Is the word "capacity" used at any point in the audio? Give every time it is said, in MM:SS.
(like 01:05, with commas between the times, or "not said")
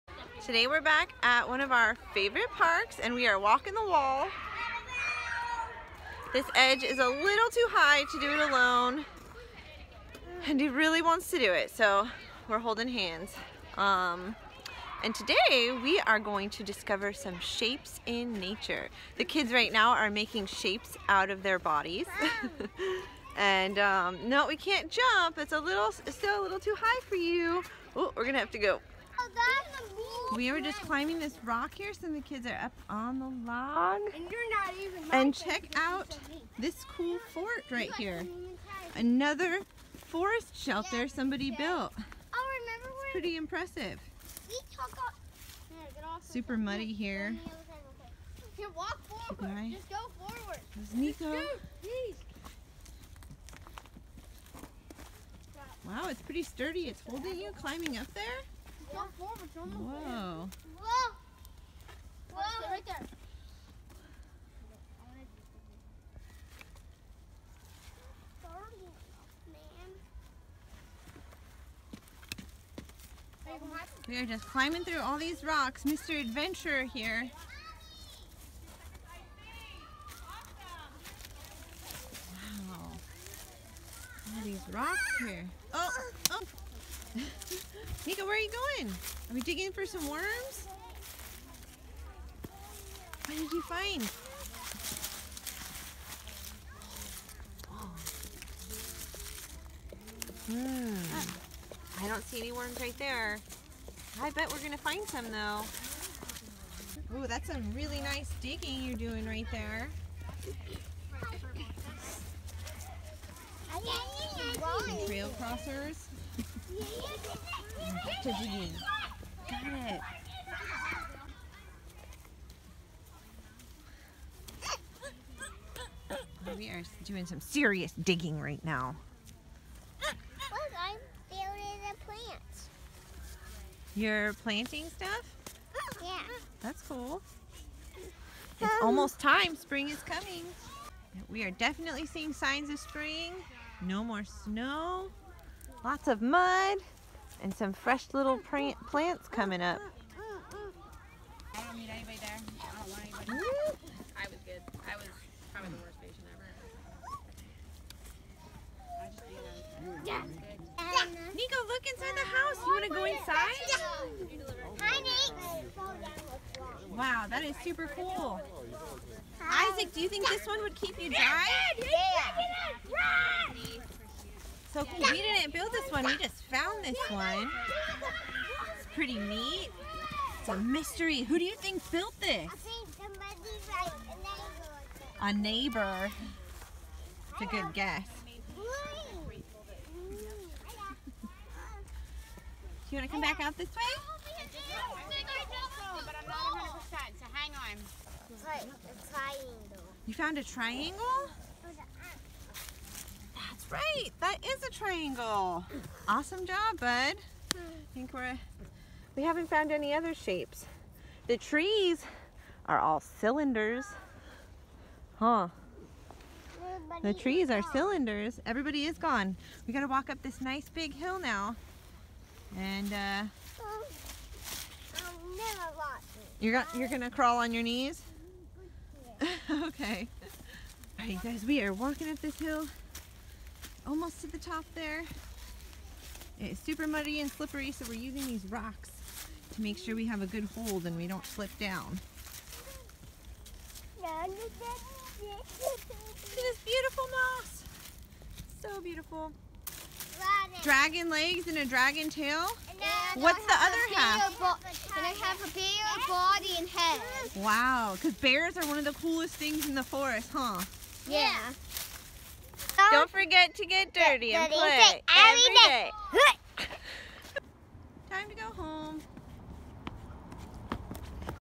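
not said.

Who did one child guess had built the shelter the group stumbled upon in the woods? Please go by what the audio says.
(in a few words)
A neighbor.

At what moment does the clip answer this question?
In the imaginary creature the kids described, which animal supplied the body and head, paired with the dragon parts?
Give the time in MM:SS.
04:15.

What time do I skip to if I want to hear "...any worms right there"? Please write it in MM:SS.
01:42.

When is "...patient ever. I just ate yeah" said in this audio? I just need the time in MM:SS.
02:35.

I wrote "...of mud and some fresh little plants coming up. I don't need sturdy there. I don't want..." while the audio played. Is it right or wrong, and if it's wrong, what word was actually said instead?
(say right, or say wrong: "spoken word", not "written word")
wrong: "anybody", not "sturdy".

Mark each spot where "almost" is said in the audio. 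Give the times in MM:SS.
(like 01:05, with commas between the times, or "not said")
02:18, 03:53.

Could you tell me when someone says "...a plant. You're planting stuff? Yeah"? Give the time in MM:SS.
02:11.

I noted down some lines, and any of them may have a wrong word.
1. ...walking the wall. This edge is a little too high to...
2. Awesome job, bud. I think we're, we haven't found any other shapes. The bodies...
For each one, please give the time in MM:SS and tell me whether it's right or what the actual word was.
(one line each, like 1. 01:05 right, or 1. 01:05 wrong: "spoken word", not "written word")
1. 00:03 right
2. 03:26 wrong: "trees", not "bodies".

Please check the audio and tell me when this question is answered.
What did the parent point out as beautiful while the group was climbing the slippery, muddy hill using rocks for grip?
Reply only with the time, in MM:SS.
04:07.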